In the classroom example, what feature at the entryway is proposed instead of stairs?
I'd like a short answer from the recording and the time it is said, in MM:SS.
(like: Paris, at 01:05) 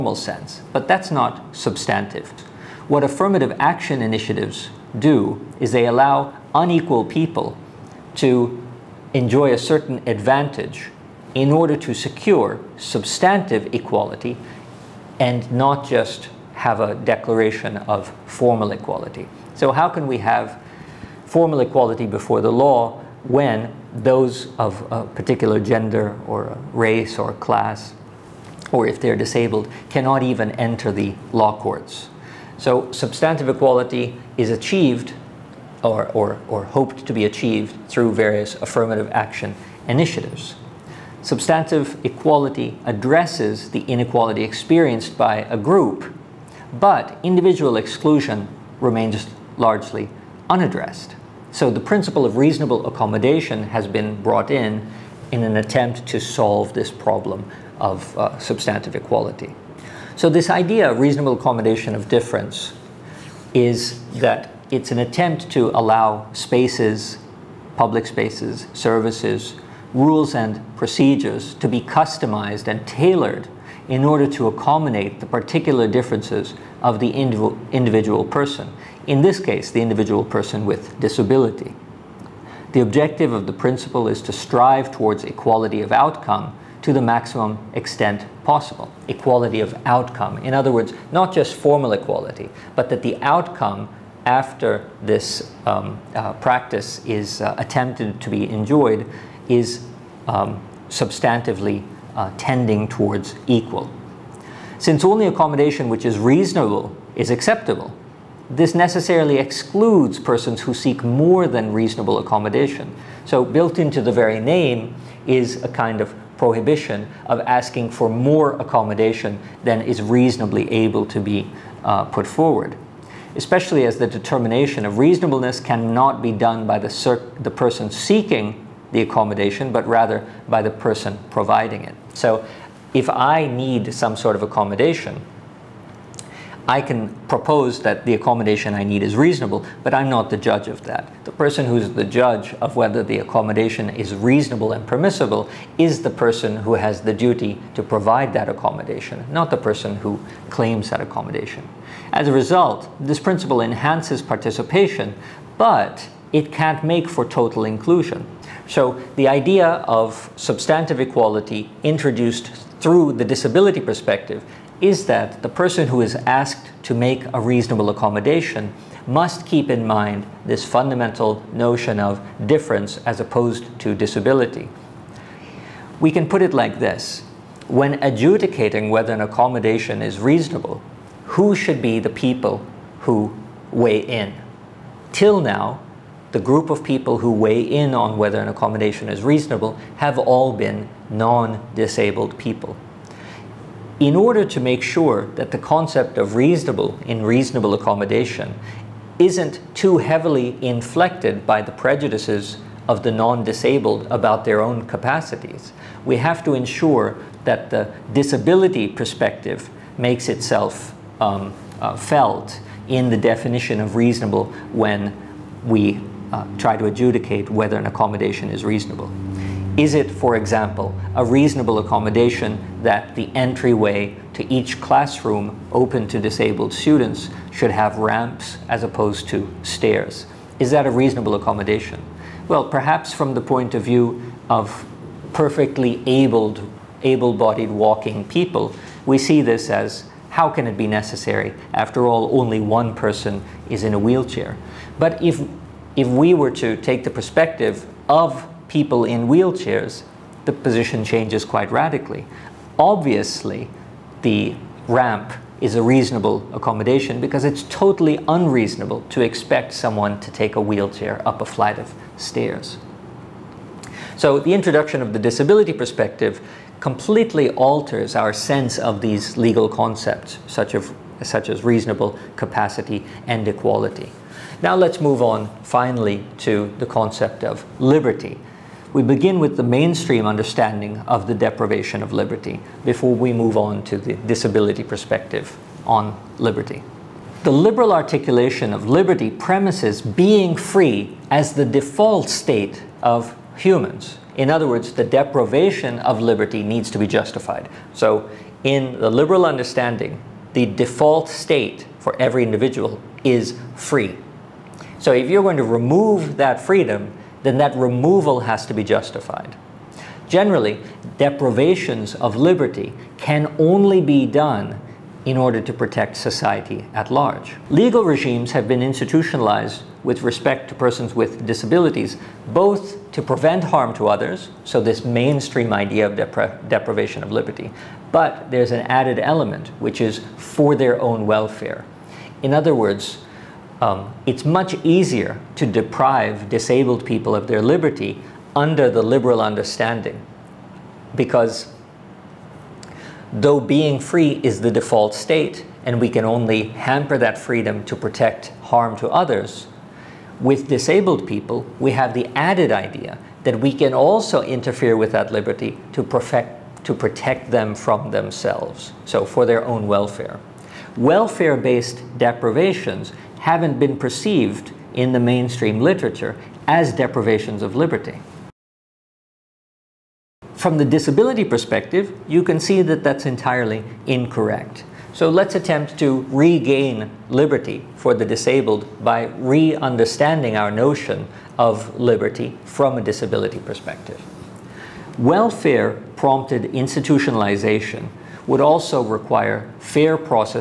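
ramps, at 03:47.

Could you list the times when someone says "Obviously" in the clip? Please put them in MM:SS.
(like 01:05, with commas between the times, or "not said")
04:12.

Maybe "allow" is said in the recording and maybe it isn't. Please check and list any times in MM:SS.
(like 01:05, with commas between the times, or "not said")
00:05, 01:05.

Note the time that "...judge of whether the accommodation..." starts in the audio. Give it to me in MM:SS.
02:22.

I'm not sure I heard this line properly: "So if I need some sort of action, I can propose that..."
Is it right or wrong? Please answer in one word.
wrong.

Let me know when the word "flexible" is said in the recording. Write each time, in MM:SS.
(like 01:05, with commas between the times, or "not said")
not said.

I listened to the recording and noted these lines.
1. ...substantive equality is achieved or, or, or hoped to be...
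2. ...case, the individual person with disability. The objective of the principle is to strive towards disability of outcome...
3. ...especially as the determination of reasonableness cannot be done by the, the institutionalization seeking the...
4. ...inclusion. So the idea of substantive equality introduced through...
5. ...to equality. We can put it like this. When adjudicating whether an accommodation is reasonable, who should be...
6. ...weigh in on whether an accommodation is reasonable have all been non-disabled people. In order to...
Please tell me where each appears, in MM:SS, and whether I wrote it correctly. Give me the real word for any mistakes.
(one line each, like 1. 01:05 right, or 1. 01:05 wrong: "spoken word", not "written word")
1. 00:32 right
2. 01:19 wrong: "equality", not "disability"
3. 02:03 wrong: "person", not "institutionalization"
4. 02:37 right
5. 02:53 wrong: "disability", not "equality"
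6. 03:07 right.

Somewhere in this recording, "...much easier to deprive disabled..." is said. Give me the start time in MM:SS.
05:34.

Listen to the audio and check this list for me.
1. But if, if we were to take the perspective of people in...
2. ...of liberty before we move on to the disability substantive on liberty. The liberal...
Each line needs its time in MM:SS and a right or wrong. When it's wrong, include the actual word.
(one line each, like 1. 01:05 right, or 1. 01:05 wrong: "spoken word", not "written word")
1. 04:04 right
2. 04:42 wrong: "perspective", not "substantive".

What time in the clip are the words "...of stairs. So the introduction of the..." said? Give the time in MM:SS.
04:21.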